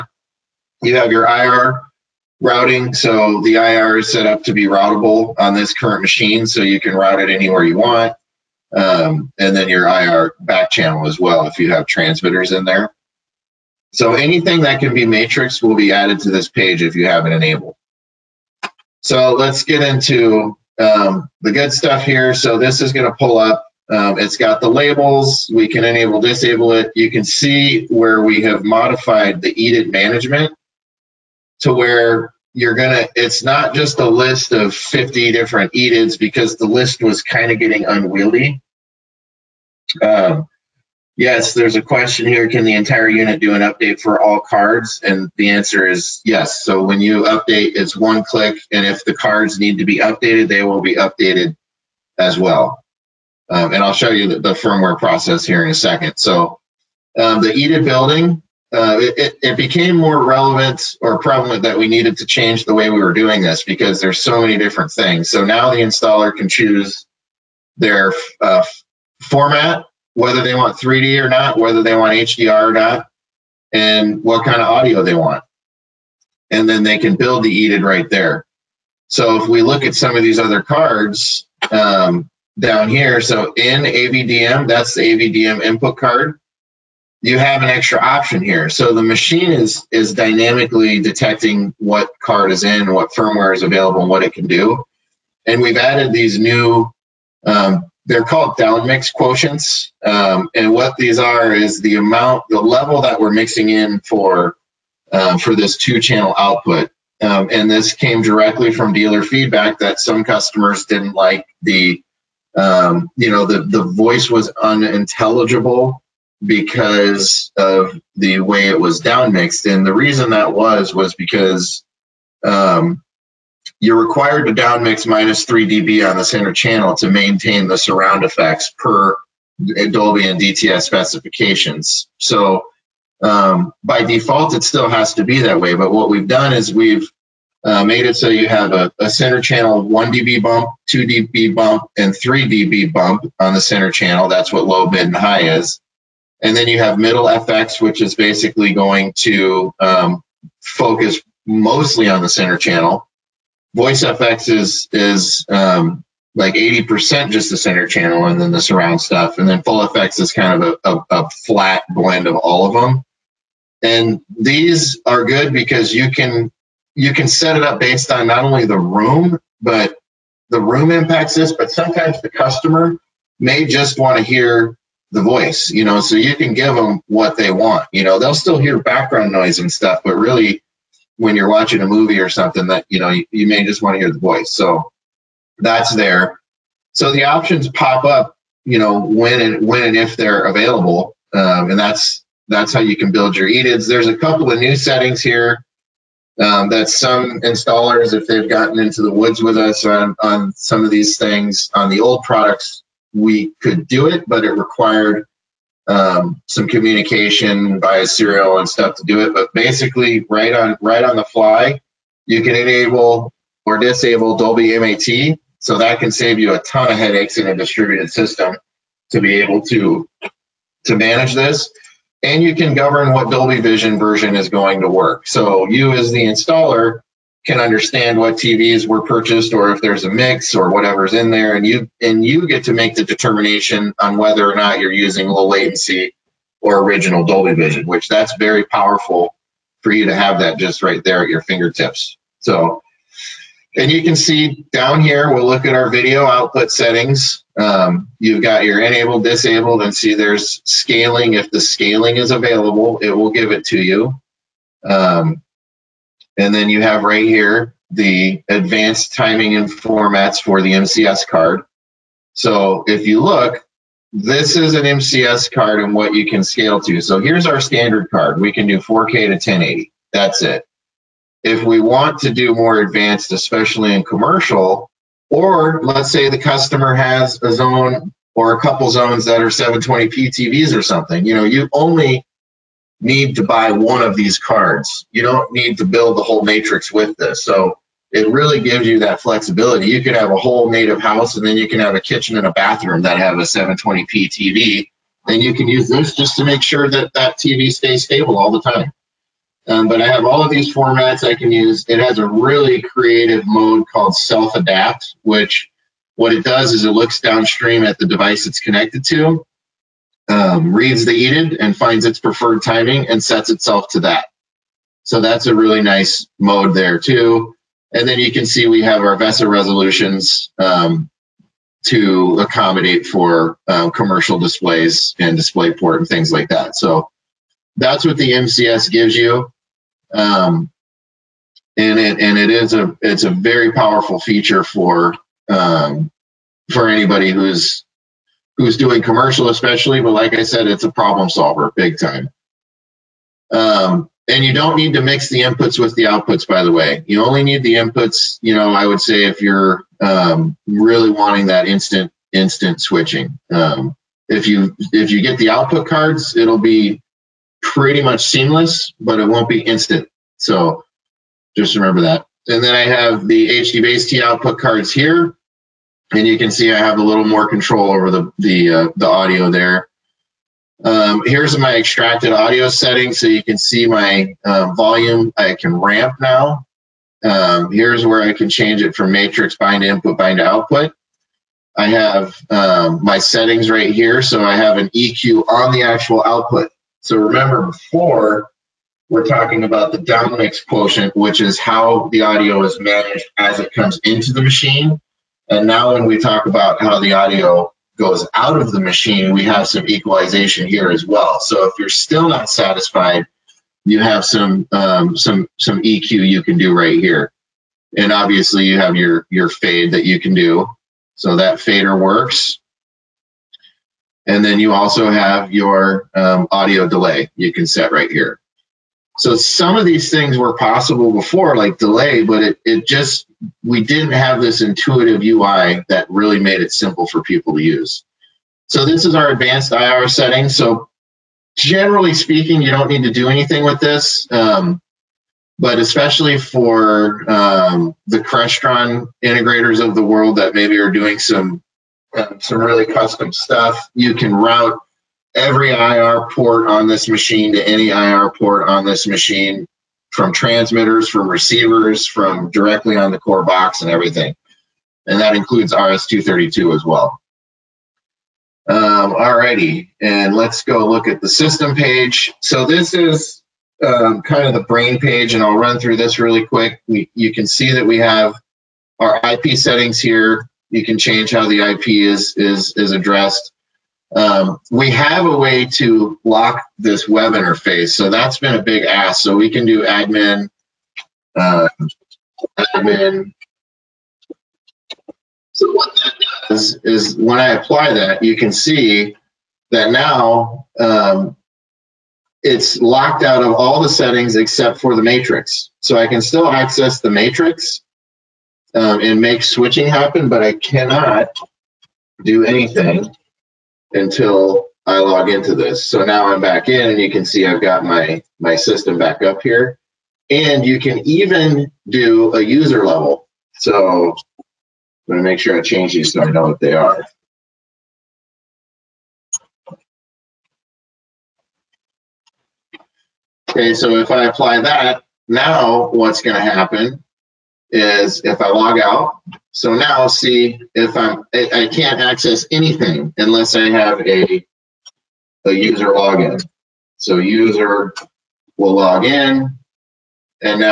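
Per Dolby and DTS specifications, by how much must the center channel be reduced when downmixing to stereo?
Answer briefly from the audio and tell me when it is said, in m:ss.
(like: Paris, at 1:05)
minus 3 dB, at 2:05.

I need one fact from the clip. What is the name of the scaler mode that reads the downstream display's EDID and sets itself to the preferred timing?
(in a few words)
self adapt.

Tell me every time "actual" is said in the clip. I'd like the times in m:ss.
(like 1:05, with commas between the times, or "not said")
6:25.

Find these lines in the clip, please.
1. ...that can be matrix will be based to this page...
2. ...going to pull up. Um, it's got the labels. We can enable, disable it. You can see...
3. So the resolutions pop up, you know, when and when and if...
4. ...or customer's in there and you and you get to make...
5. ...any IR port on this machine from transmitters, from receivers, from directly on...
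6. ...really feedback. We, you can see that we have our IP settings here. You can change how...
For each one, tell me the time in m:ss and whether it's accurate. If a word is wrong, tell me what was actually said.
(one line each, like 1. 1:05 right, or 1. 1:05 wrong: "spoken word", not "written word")
1. 0:14 wrong: "added", not "based"
2. 0:22 right
3. 3:06 wrong: "options", not "resolutions"
4. 3:50 wrong: "whatever", not "customer"
5. 7:27 right
6. 7:46 wrong: "quick", not "feedback".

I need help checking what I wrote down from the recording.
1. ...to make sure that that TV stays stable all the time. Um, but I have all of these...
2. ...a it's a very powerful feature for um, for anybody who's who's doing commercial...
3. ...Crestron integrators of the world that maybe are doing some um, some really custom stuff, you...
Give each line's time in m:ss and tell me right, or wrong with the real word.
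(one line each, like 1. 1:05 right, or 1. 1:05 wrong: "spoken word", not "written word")
1. 4:56 right
2. 5:32 right
3. 7:18 right.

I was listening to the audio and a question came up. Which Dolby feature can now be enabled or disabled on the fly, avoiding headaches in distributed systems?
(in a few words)
Dolby MAT.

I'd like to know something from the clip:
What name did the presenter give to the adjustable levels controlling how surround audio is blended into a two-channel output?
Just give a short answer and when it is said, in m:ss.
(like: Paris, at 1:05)
downmix quotients, at 1:38.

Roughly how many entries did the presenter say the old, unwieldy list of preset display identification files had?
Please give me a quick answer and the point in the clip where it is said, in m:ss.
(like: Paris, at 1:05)
50, at 0:34.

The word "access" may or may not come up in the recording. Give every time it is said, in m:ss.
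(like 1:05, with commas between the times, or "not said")
8:16, 8:52.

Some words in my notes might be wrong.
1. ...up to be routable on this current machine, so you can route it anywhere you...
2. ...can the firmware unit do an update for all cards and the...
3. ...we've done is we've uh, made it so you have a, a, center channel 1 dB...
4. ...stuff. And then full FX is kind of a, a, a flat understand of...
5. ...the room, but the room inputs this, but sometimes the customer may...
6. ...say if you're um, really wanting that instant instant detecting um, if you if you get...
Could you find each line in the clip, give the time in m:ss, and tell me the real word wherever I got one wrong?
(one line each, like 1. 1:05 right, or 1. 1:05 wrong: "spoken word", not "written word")
1. 0:04 right
2. 0:42 wrong: "entire", not "firmware"
3. 2:16 right
4. 2:38 wrong: "blend", not "understand"
5. 2:48 wrong: "impacts", not "inputs"
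6. 5:49 wrong: "switching", not "detecting".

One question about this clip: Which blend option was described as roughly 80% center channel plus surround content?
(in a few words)
Voice FX.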